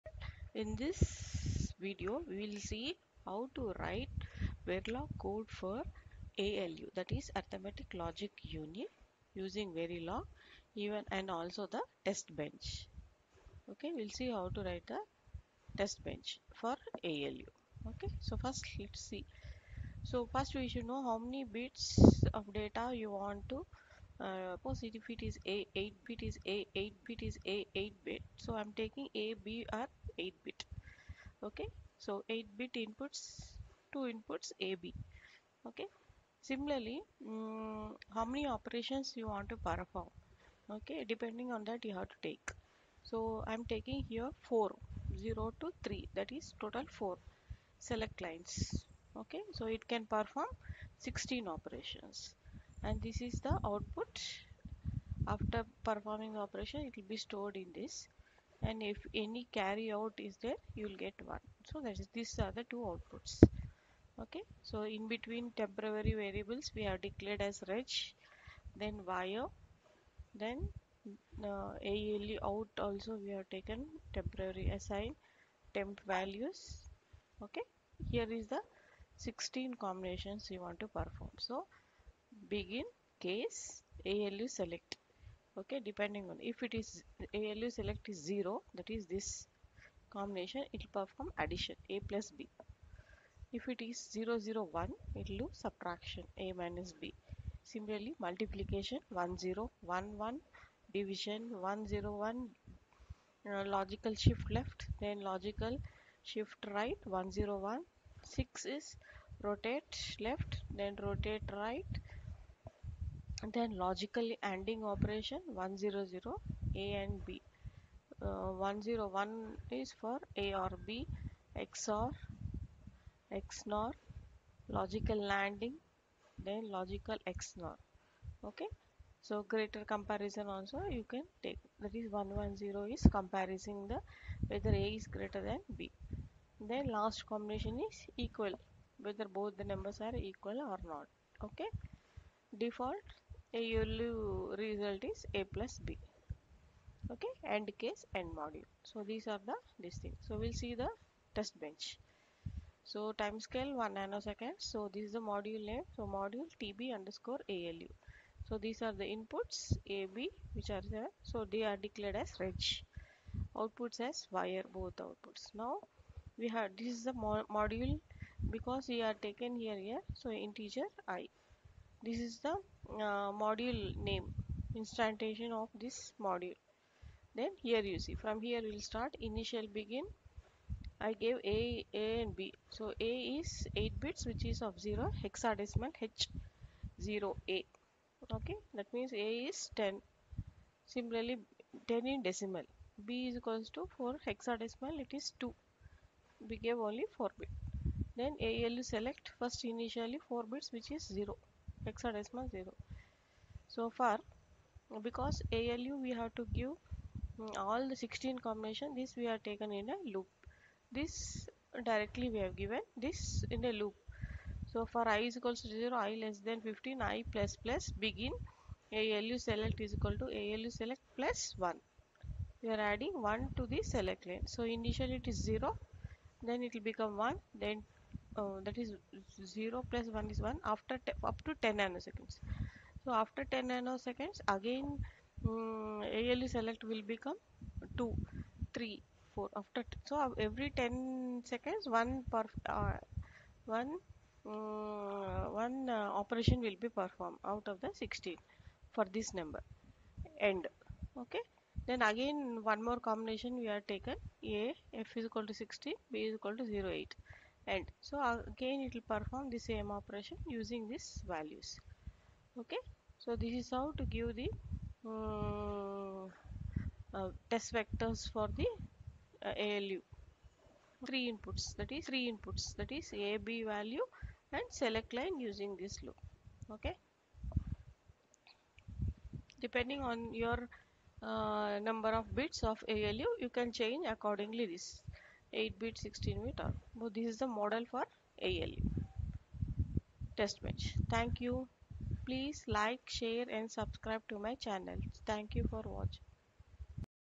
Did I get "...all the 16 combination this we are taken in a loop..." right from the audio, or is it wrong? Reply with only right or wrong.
right.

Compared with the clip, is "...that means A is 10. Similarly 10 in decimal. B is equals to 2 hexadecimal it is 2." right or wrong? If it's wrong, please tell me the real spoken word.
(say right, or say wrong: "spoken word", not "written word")
wrong: "4", not "2".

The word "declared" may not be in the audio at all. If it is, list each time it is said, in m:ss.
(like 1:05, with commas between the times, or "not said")
1:07, 2:41.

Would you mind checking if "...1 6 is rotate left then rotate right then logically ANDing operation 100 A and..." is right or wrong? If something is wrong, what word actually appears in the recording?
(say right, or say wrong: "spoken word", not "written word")
right.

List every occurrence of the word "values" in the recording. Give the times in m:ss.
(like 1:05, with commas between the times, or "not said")
1:16, 4:21, 4:33.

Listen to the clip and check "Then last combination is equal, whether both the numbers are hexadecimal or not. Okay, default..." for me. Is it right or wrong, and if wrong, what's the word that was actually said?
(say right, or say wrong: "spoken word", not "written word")
wrong: "equal", not "hexadecimal".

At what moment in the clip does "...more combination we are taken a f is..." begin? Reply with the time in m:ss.
4:12.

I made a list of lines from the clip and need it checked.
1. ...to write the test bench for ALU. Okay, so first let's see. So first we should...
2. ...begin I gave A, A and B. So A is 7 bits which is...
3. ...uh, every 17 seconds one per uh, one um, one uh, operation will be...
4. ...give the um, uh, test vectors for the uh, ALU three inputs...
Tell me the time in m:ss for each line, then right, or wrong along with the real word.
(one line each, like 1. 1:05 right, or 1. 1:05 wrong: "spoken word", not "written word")
1. 0:14 right
2. 2:59 wrong: "8", not "7"
3. 4:00 wrong: "10", not "17"
4. 4:24 right.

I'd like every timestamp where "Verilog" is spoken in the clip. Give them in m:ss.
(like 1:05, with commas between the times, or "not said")
0:04, 0:09.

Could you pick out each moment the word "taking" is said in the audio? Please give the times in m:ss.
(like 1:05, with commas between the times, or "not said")
0:28, 0:43.